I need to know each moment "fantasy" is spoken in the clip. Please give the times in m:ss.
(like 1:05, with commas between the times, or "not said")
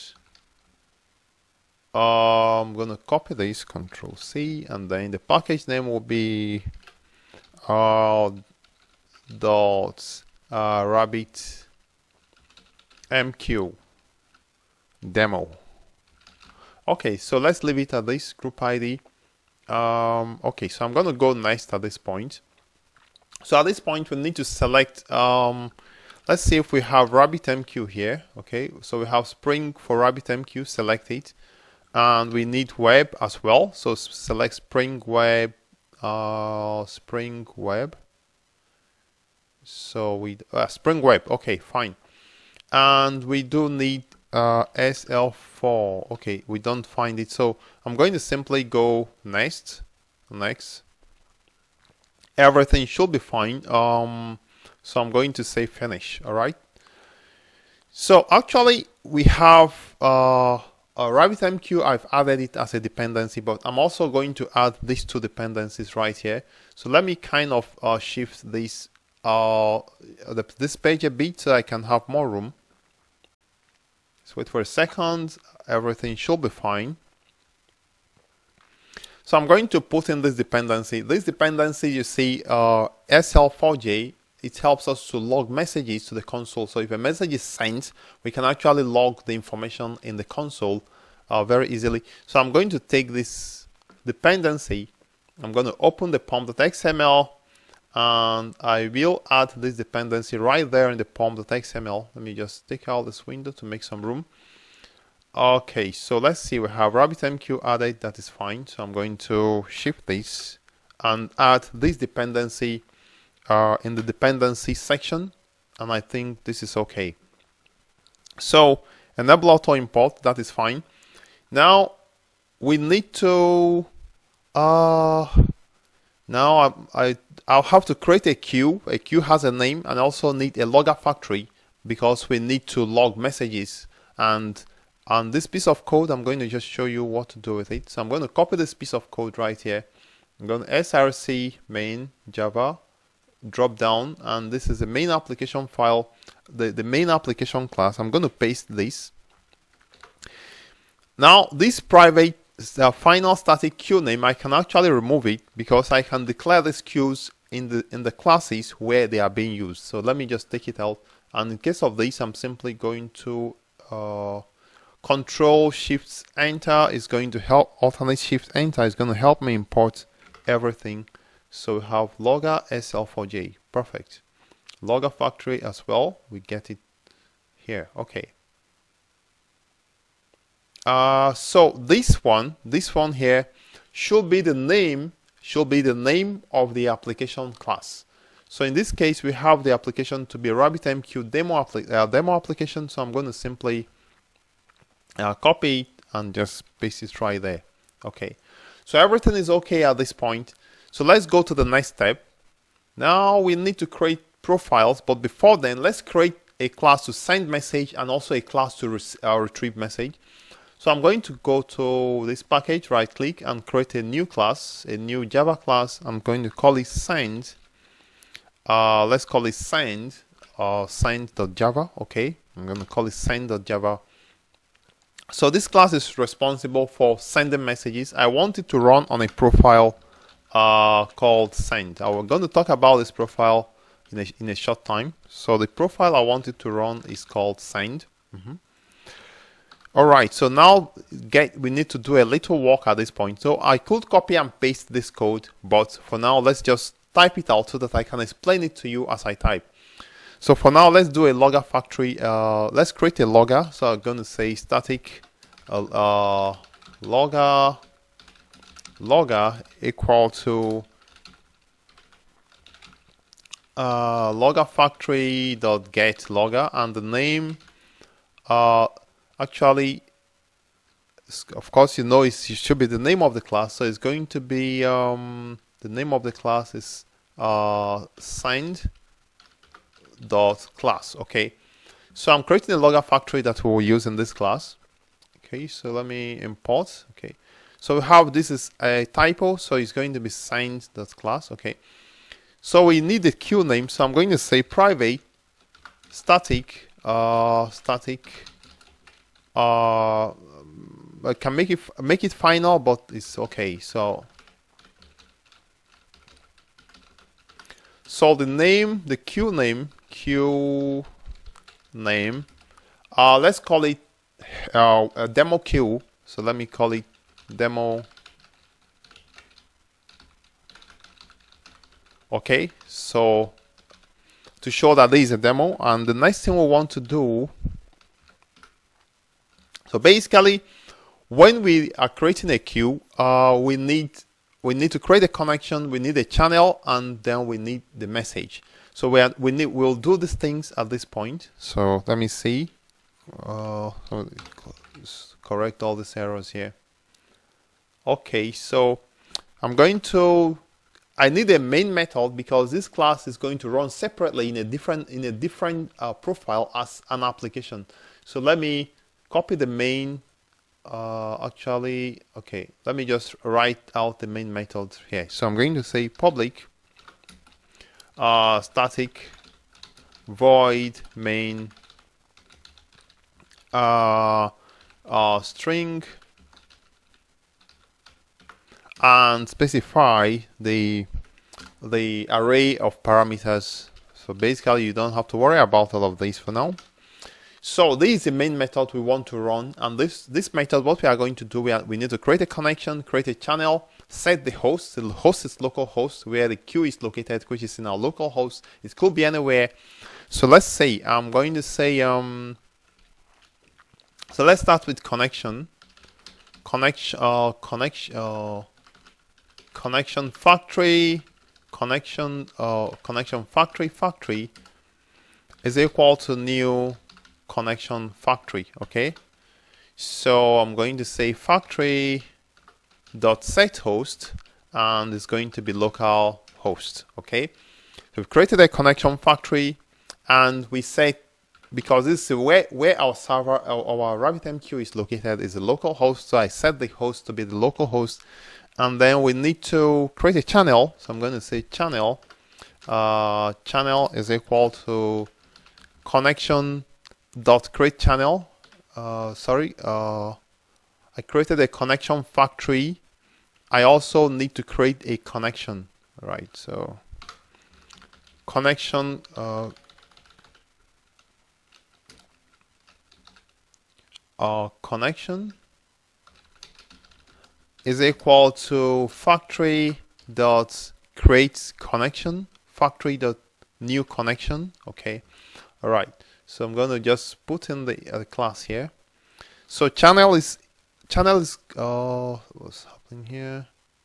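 not said.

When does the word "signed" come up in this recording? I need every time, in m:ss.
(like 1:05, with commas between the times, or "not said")
4:38, 4:50.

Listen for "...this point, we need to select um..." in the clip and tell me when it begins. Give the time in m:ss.
0:23.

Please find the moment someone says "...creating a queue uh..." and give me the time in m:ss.
5:32.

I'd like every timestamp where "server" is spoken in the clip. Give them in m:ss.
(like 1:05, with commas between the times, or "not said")
7:13.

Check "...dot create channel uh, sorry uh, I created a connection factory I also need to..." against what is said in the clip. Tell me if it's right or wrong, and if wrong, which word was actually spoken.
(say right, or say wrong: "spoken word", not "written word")
right.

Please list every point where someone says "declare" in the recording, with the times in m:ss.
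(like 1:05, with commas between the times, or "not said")
2:36.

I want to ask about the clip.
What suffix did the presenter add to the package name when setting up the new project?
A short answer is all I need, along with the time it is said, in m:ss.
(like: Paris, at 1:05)
rabbitmq demo, at 0:10.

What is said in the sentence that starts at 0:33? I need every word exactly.
So select Spring Web, uh, Spring Web.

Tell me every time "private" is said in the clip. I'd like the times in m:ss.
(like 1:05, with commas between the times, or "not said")
2:31, 4:54.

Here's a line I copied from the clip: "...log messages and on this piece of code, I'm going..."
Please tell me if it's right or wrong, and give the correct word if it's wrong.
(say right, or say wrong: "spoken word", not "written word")
right.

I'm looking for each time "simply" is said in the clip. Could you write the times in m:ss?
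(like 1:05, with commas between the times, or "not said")
0:48, 2:42, 3:13.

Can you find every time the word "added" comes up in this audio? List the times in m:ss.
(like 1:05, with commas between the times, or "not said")
1:02, 1:47.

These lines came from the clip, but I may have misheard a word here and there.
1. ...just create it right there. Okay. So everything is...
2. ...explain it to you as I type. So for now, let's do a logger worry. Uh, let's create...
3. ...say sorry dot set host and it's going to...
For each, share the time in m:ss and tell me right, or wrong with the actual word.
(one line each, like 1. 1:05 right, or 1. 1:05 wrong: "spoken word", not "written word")
1. 3:16 wrong: "paste", not "create"
2. 4:08 wrong: "factory", not "worry"
3. 7:01 wrong: "factory", not "sorry".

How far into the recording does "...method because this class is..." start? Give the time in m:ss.
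5:51.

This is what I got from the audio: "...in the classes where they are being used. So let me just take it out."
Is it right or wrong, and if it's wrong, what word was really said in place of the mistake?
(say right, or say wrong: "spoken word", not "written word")
right.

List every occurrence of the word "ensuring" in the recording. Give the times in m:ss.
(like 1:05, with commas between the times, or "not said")
not said.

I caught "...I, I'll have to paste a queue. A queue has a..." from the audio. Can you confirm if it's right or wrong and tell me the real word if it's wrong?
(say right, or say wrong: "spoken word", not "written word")
wrong: "create", not "paste".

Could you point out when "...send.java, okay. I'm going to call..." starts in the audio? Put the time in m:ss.
3:40.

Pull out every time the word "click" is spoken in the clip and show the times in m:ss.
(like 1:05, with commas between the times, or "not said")
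3:33.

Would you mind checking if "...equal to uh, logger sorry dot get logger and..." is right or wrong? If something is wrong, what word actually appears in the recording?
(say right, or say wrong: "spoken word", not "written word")
wrong: "factory", not "sorry".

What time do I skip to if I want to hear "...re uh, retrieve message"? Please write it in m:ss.
3:28.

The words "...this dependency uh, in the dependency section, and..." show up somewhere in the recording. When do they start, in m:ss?
1:51.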